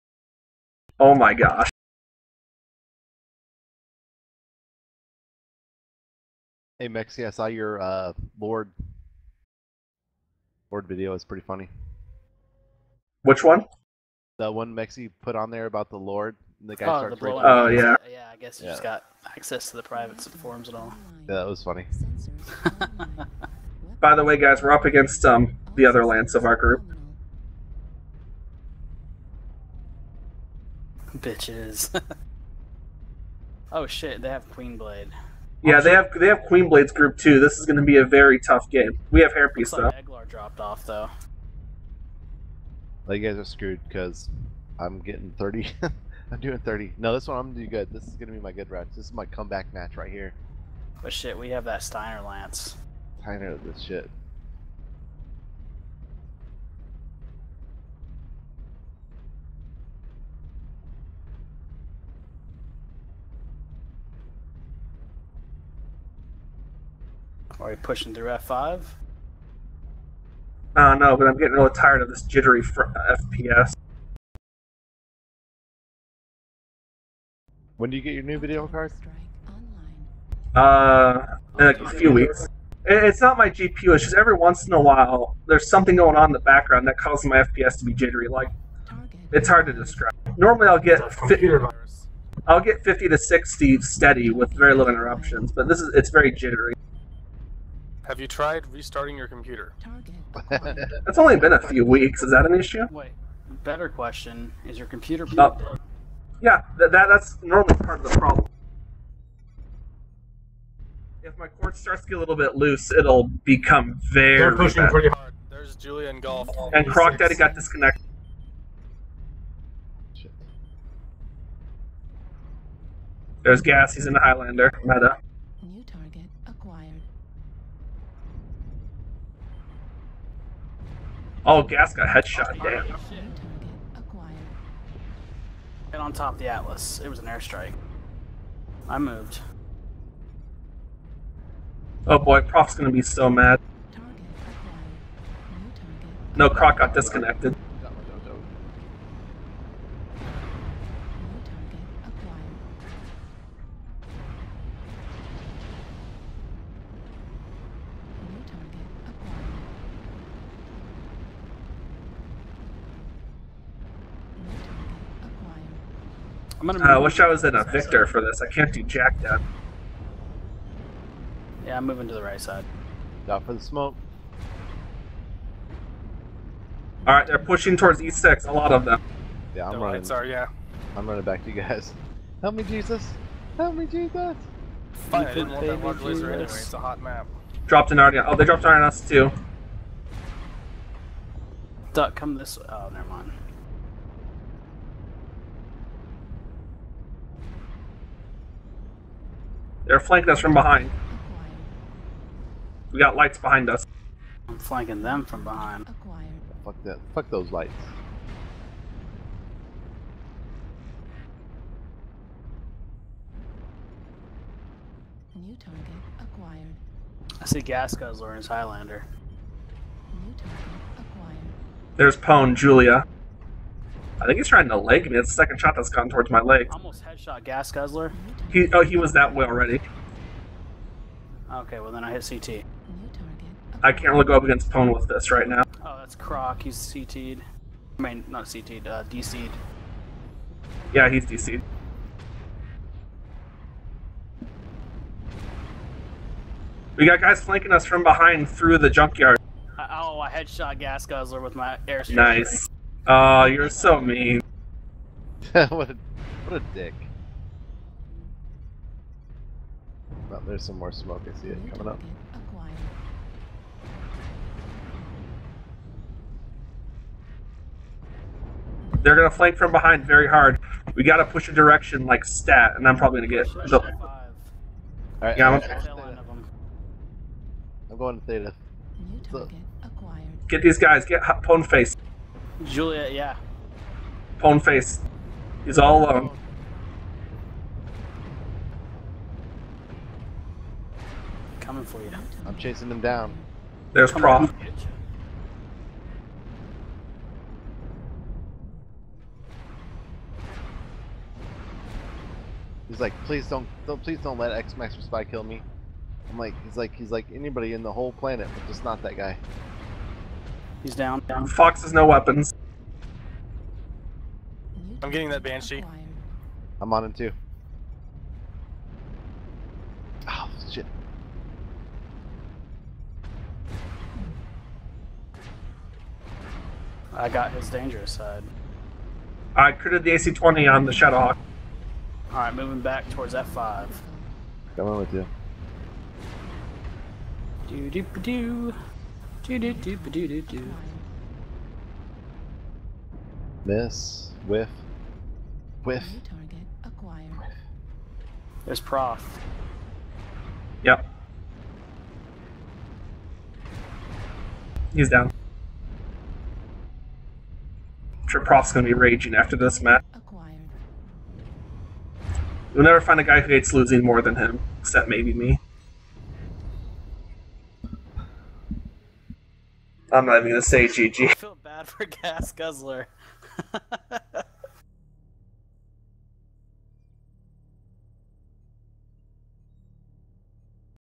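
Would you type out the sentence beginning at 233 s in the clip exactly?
I can't really go up against Pwn with this right now.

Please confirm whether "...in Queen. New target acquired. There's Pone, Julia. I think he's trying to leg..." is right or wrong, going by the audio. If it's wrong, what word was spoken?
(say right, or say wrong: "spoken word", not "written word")
wrong: "Highlander", not "Queen".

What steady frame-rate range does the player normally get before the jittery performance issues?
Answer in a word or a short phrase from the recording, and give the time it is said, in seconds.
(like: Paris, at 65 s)
50 to 60, at 92 s.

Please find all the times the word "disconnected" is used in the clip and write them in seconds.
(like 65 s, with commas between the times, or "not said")
117 s, 146 s.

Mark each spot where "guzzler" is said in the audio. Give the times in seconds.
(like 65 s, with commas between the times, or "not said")
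217 s, 227 s, 251 s, 372 s.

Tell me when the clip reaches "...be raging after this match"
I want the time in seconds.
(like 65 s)
358 s.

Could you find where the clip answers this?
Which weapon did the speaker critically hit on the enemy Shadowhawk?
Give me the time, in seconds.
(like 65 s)
330 s.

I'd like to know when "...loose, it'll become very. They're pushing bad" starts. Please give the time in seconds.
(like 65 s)
112 s.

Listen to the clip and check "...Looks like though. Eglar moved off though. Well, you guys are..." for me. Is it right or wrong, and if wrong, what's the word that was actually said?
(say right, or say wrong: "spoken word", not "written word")
wrong: "dropped", not "moved".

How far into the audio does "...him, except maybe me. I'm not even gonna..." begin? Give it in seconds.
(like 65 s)
364 s.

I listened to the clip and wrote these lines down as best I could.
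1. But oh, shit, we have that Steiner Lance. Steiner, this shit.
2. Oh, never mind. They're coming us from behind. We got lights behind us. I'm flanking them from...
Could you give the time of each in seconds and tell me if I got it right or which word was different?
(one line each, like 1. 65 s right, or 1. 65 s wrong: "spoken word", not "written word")
1. 51 s right
2. 192 s wrong: "flanking", not "coming".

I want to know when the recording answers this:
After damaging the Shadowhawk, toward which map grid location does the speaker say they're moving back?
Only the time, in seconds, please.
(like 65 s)
333 s.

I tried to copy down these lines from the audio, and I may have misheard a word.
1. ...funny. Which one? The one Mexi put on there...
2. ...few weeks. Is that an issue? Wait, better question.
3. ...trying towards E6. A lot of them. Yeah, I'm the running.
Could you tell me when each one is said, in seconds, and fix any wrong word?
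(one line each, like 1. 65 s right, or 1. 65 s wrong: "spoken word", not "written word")
1. 11 s right
2. 101 s right
3. 177 s wrong: "pushing", not "trying".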